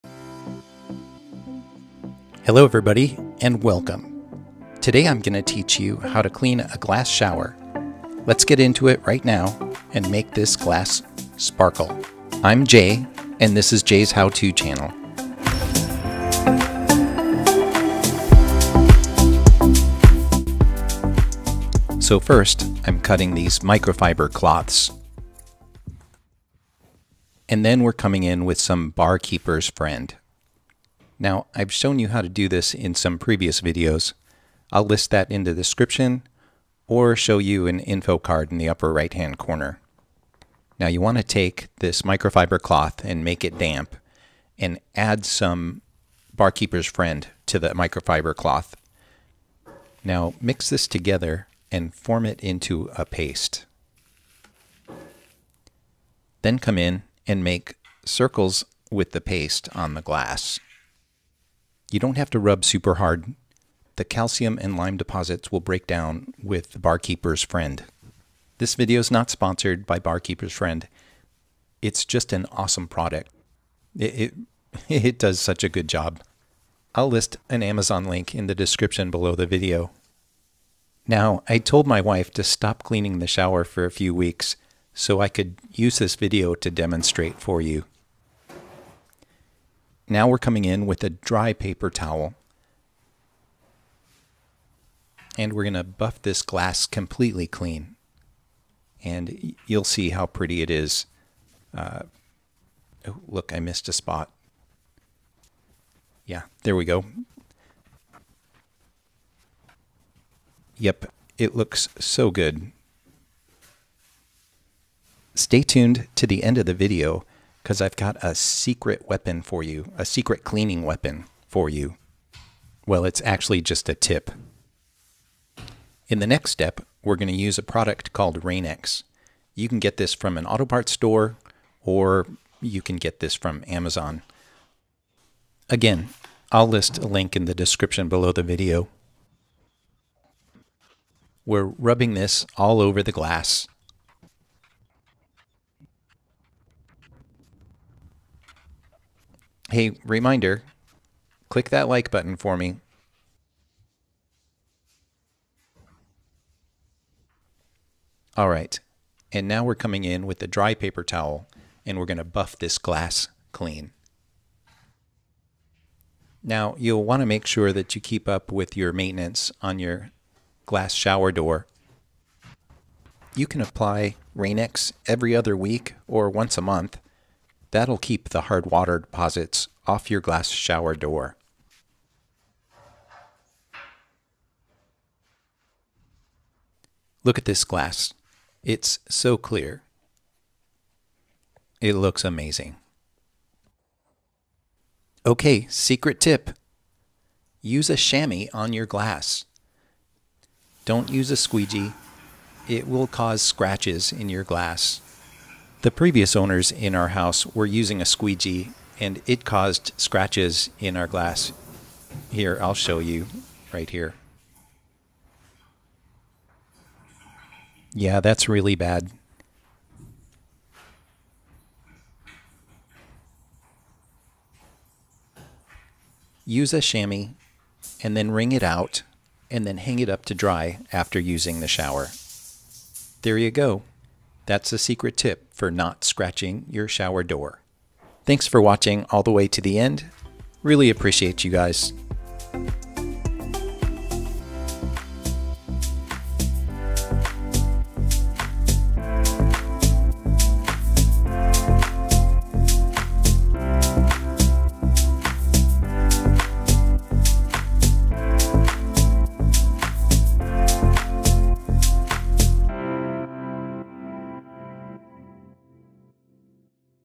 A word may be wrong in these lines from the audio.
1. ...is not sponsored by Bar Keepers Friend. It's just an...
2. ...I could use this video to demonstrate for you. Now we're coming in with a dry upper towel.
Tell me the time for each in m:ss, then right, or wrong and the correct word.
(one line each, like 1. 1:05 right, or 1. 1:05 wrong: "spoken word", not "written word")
1. 1:09 right
2. 1:25 wrong: "paper", not "upper".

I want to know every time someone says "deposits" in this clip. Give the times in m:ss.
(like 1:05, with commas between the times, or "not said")
1:04, 2:58.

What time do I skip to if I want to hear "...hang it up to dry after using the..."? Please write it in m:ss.
3:49.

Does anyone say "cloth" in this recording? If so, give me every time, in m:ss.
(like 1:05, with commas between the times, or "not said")
0:24, 0:42, 0:48.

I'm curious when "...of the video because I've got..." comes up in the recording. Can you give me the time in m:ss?
1:56.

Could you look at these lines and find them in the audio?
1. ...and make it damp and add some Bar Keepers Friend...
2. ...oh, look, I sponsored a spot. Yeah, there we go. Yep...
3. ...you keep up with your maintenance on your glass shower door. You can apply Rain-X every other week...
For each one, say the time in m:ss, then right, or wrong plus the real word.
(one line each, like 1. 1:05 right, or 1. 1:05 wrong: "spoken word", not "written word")
1. 0:43 right
2. 1:43 wrong: "missed", not "sponsored"
3. 2:47 right.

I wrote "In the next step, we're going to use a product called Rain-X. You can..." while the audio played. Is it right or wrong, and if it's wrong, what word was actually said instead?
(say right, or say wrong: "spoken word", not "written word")
right.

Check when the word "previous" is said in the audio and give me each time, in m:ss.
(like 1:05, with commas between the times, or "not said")
0:33, 3:25.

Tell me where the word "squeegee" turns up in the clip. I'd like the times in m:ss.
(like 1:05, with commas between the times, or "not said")
3:21, 3:28.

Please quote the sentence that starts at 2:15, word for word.
Again, I'll list a link in the description below the video.